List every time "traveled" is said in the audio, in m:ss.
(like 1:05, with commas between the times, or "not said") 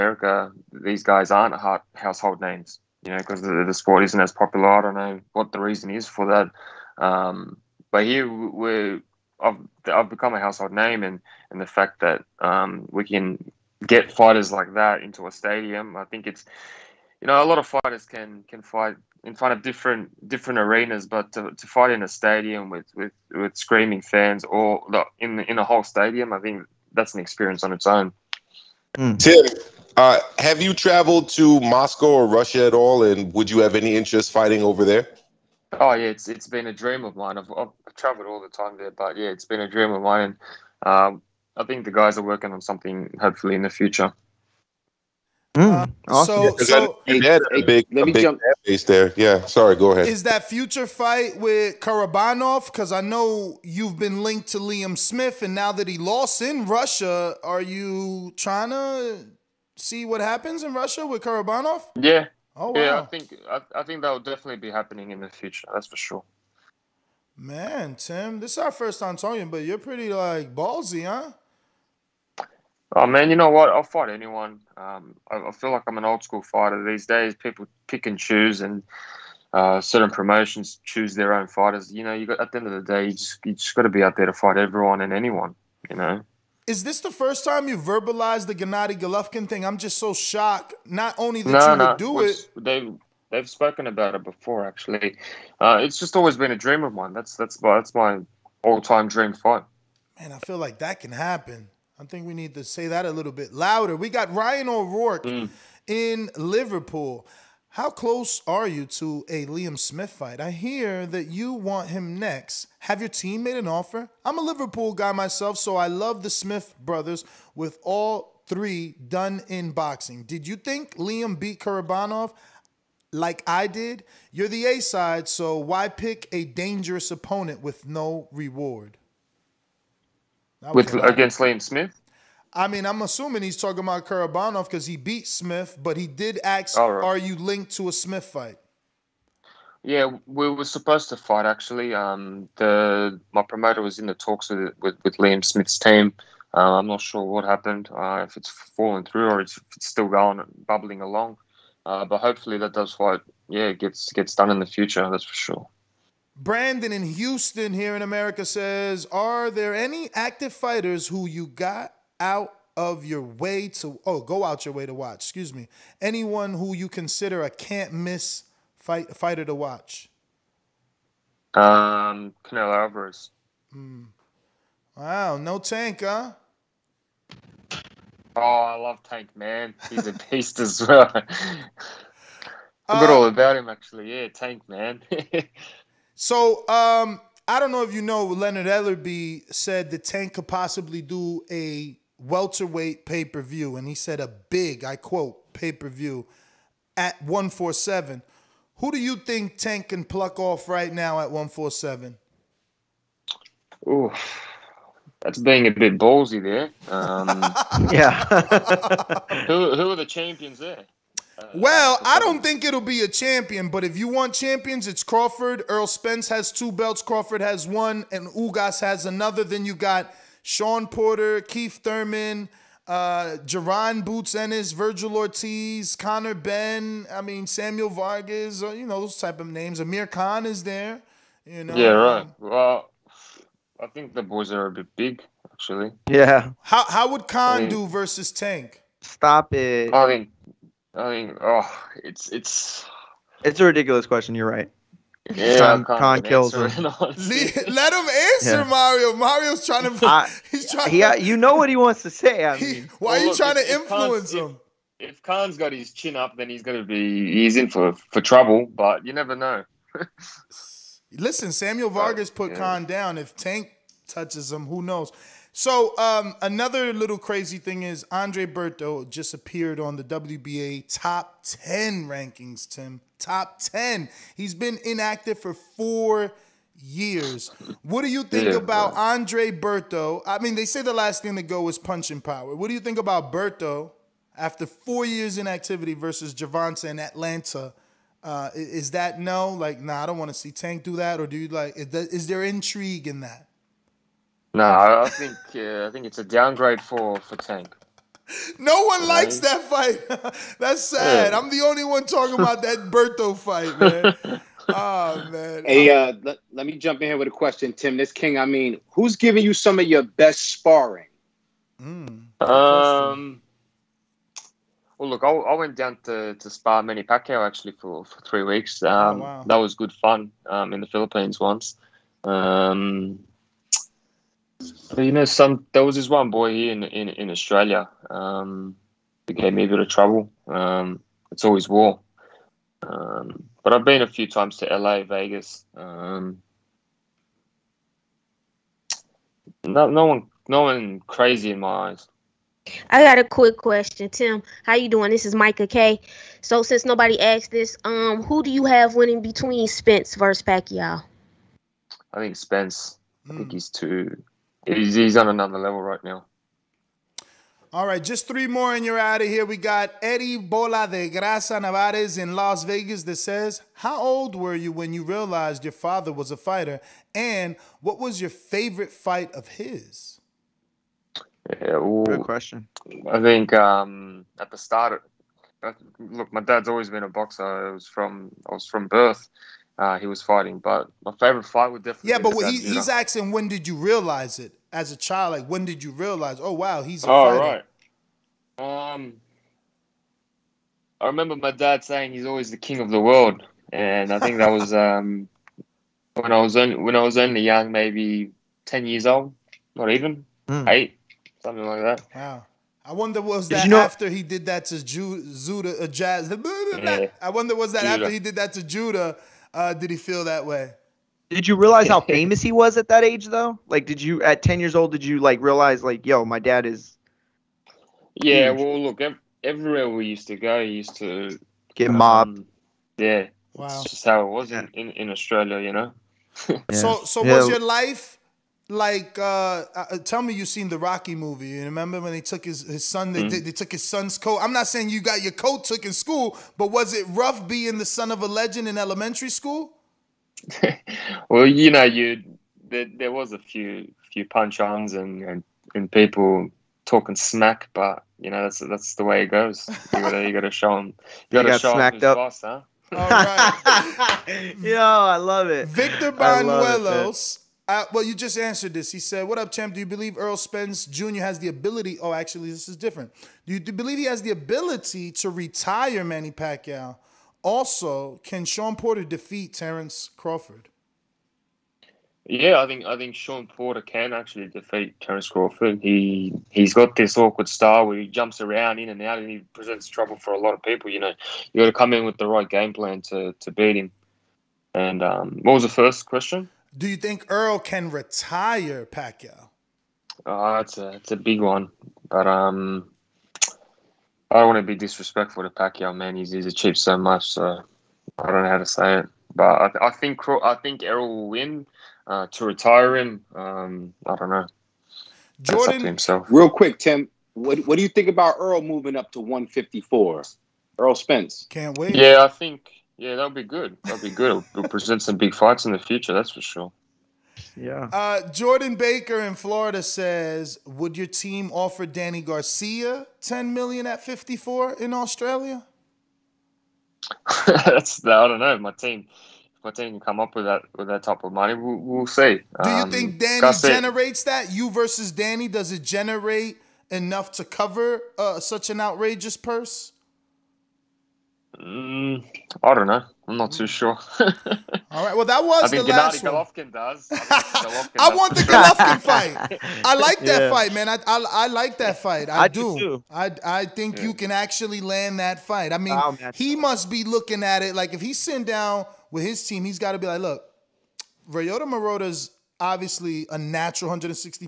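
0:30, 0:37.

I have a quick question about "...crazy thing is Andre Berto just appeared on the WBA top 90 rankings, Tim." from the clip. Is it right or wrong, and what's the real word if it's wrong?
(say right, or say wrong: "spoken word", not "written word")
wrong: "10", not "90".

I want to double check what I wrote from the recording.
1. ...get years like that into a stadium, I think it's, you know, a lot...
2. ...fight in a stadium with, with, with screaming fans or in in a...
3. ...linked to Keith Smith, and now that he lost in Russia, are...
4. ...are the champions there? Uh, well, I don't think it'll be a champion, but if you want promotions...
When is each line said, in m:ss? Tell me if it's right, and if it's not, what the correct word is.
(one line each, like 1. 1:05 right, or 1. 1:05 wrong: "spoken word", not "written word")
1. 0:13 wrong: "fighters", not "years"
2. 0:21 right
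3. 0:54 wrong: "Liam", not "Keith"
4. 3:29 wrong: "champions", not "promotions".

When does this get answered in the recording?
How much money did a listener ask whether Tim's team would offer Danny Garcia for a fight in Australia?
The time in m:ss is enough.
8:43.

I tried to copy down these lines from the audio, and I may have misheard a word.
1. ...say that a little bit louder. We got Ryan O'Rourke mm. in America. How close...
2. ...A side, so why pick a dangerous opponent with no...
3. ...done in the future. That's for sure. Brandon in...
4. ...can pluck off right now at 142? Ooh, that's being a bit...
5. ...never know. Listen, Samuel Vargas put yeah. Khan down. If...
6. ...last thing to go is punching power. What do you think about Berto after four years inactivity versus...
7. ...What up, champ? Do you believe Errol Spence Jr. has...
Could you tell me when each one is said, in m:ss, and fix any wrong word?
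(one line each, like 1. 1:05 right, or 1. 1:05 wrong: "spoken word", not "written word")
1. 1:42 wrong: "Liverpool", not "America"
2. 2:04 right
3. 2:34 right
4. 3:19 wrong: "147", not "142"
5. 4:19 right
6. 4:40 right
7. 7:39 right.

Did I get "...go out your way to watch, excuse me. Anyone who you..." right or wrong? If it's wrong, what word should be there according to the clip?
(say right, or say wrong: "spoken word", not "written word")
right.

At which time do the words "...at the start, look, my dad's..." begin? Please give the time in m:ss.
6:14.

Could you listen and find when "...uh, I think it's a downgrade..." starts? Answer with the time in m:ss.
4:55.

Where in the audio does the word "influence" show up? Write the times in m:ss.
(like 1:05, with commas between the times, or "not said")
4:13.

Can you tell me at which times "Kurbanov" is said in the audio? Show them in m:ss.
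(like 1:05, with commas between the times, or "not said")
0:51, 1:01, 2:01, 2:14.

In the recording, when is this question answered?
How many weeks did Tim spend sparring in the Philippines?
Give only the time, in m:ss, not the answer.
5:18.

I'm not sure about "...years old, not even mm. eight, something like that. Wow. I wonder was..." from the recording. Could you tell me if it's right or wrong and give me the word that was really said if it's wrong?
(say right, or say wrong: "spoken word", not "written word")
right.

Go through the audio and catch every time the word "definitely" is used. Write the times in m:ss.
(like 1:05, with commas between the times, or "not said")
1:04, 6:21.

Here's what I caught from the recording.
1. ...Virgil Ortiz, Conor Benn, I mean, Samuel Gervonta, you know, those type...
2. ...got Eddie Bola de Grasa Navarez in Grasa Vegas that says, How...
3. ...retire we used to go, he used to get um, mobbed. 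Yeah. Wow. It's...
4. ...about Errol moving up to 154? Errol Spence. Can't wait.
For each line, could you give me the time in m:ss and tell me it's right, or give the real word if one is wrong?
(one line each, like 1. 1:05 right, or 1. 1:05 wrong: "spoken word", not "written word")
1. 3:44 wrong: "Vargas", not "Gervonta"
2. 5:59 wrong: "Las", not "Grasa"
3. 6:59 wrong: "everywhere", not "retire"
4. 8:28 right.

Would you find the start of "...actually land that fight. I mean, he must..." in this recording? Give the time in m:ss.
9:14.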